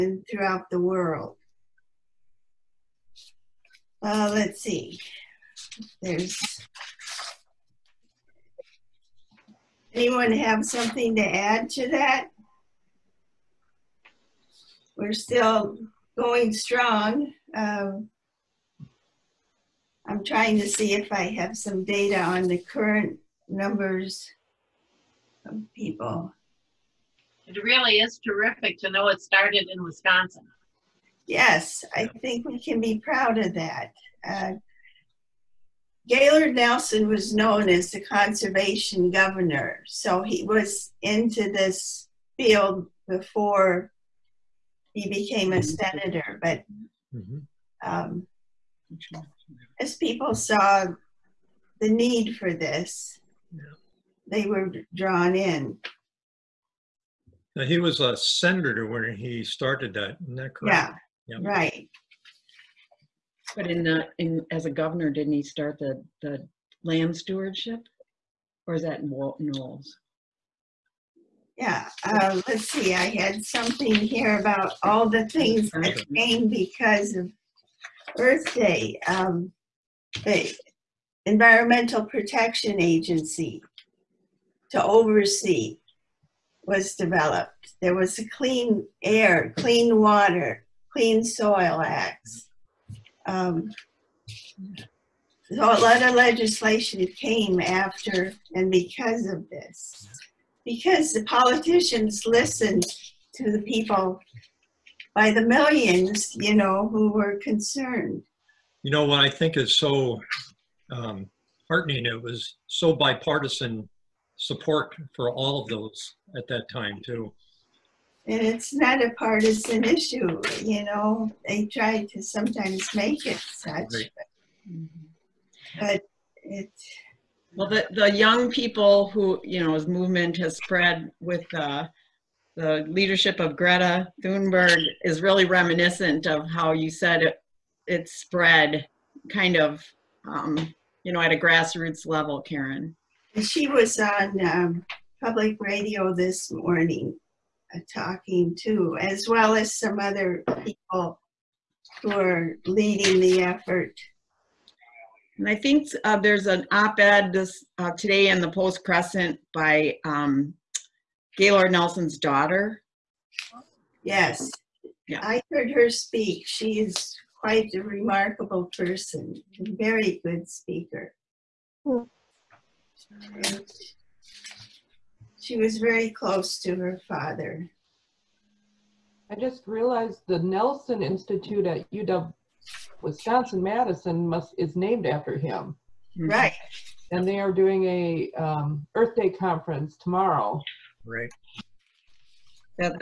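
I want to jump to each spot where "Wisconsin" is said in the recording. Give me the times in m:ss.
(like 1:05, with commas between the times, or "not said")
0:29, 3:03.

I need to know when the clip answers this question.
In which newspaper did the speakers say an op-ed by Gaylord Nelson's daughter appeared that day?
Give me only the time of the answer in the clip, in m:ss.
2:38.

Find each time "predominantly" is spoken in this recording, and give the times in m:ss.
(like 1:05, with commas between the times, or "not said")
not said.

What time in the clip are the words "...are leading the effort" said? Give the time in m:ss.
2:32.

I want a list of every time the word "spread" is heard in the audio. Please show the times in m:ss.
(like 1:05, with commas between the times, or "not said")
2:10, 2:18.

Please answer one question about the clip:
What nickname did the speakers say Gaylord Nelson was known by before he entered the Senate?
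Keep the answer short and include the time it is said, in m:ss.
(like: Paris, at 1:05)
the conservation governor, at 0:37.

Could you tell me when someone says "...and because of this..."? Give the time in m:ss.
1:38.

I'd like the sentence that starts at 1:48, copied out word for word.
You know what I think is so um, heartening.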